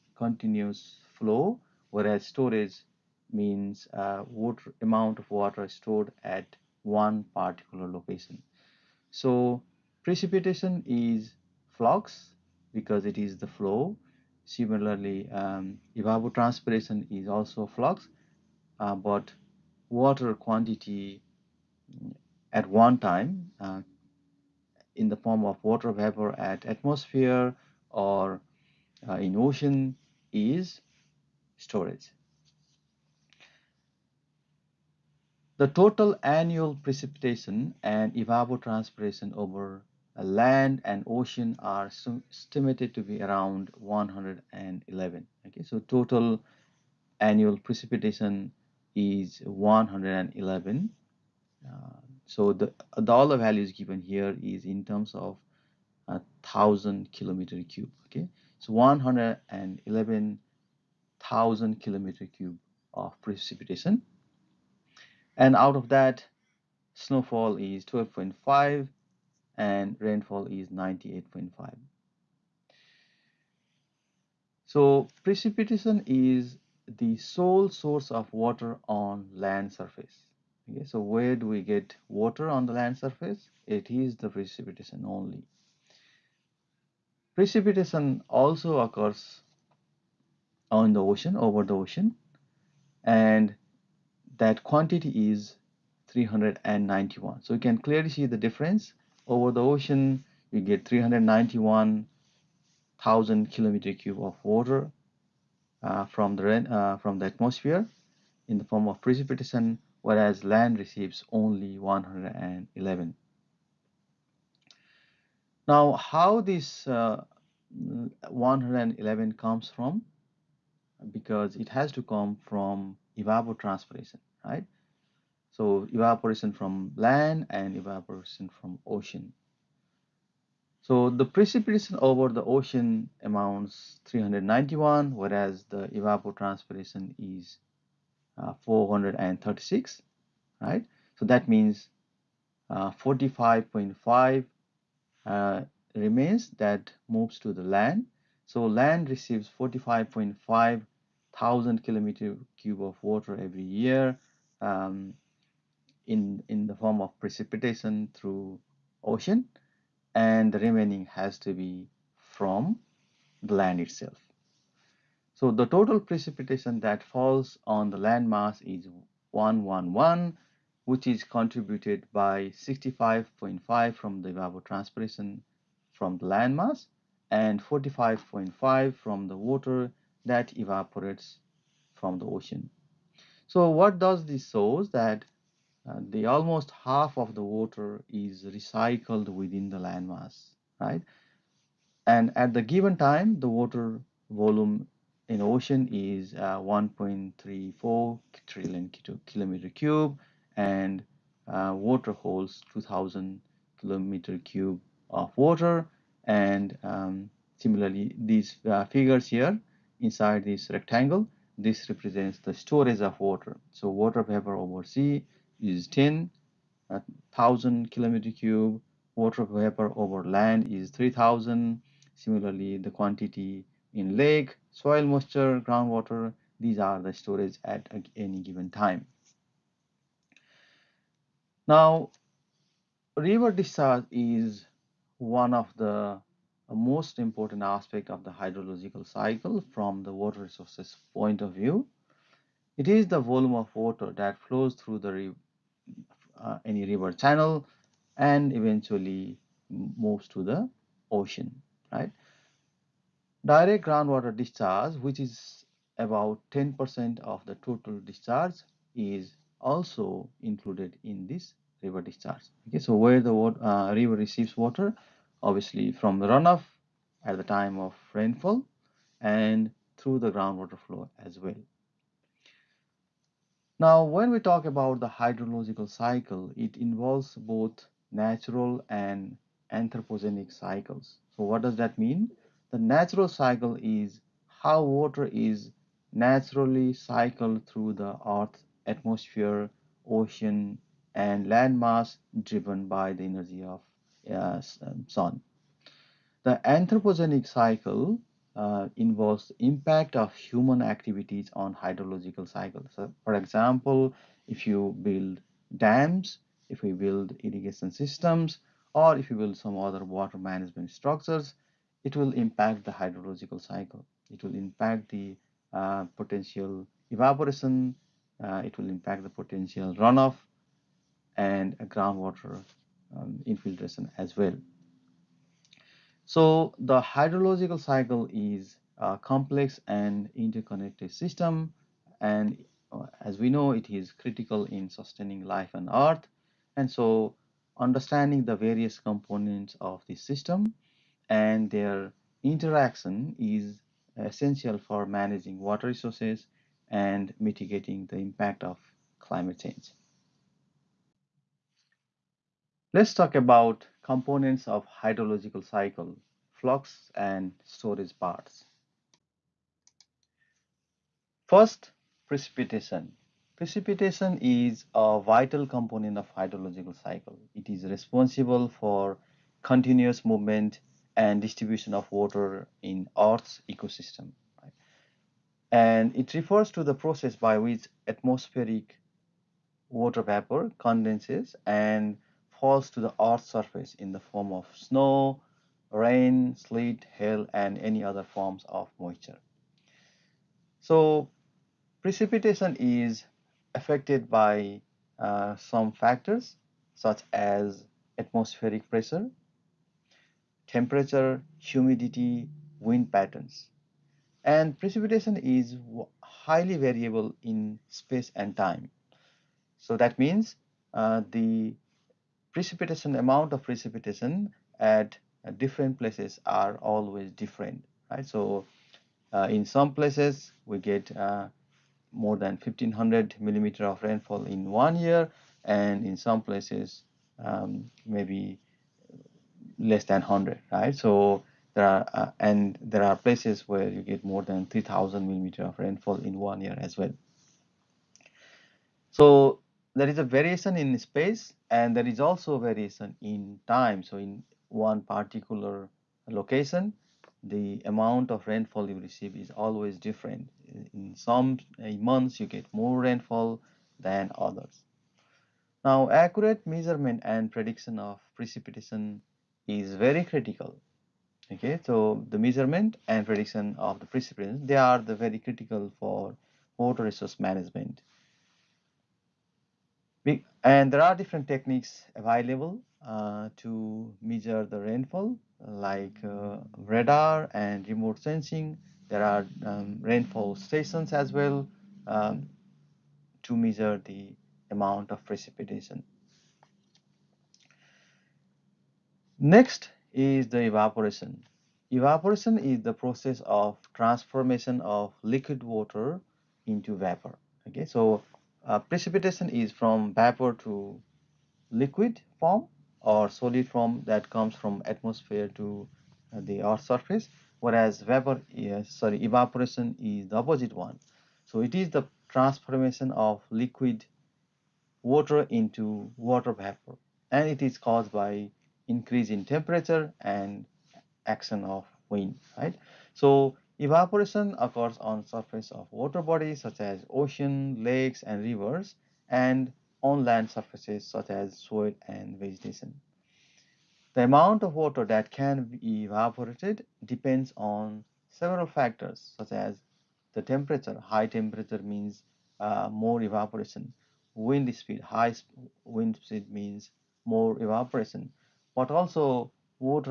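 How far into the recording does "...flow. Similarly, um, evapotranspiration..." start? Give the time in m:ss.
0:13.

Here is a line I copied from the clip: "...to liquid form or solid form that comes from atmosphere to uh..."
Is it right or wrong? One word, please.
right.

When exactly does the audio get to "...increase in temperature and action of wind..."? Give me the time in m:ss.
8:38.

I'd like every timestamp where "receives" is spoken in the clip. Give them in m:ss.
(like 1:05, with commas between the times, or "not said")
1:50, 2:29, 4:24, 7:28.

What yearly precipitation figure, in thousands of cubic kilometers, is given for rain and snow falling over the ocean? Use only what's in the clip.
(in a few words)
391.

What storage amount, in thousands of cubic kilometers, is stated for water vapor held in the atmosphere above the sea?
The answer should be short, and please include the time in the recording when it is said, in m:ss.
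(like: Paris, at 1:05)
10, at 3:33.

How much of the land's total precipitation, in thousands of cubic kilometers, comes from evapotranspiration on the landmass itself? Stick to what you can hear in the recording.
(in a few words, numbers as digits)
65.5.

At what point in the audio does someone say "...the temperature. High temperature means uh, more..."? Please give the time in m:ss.
9:00.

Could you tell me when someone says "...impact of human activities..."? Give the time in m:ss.
4:59.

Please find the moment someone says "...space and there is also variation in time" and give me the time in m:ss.
7:20.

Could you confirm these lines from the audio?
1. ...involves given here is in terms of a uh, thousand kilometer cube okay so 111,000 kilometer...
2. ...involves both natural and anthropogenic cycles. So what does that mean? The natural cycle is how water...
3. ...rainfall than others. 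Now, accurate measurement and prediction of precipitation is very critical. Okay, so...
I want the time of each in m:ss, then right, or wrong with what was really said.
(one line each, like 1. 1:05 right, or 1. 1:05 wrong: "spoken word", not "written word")
1. 0:53 wrong: "values", not "involves"
2. 4:36 right
3. 7:33 right.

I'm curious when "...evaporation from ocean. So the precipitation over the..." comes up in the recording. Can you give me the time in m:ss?
2:07.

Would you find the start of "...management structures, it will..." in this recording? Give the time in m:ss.
5:10.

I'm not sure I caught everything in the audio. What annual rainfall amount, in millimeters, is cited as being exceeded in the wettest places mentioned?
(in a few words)
3000.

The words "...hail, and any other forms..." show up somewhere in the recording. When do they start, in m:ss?
6:27.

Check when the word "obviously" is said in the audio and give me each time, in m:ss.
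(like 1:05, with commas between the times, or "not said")
4:25.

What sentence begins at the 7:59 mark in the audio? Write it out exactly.
There are um, rainfall stations as well um, to measure the amount of precipitation.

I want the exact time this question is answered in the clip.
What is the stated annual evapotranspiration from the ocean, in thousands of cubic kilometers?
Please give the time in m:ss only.
2:15.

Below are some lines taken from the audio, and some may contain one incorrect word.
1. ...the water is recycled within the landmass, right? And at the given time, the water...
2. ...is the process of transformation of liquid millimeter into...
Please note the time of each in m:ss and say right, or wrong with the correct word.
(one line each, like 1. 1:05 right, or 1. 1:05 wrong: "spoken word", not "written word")
1. 3:07 right
2. 8:12 wrong: "water", not "millimeter".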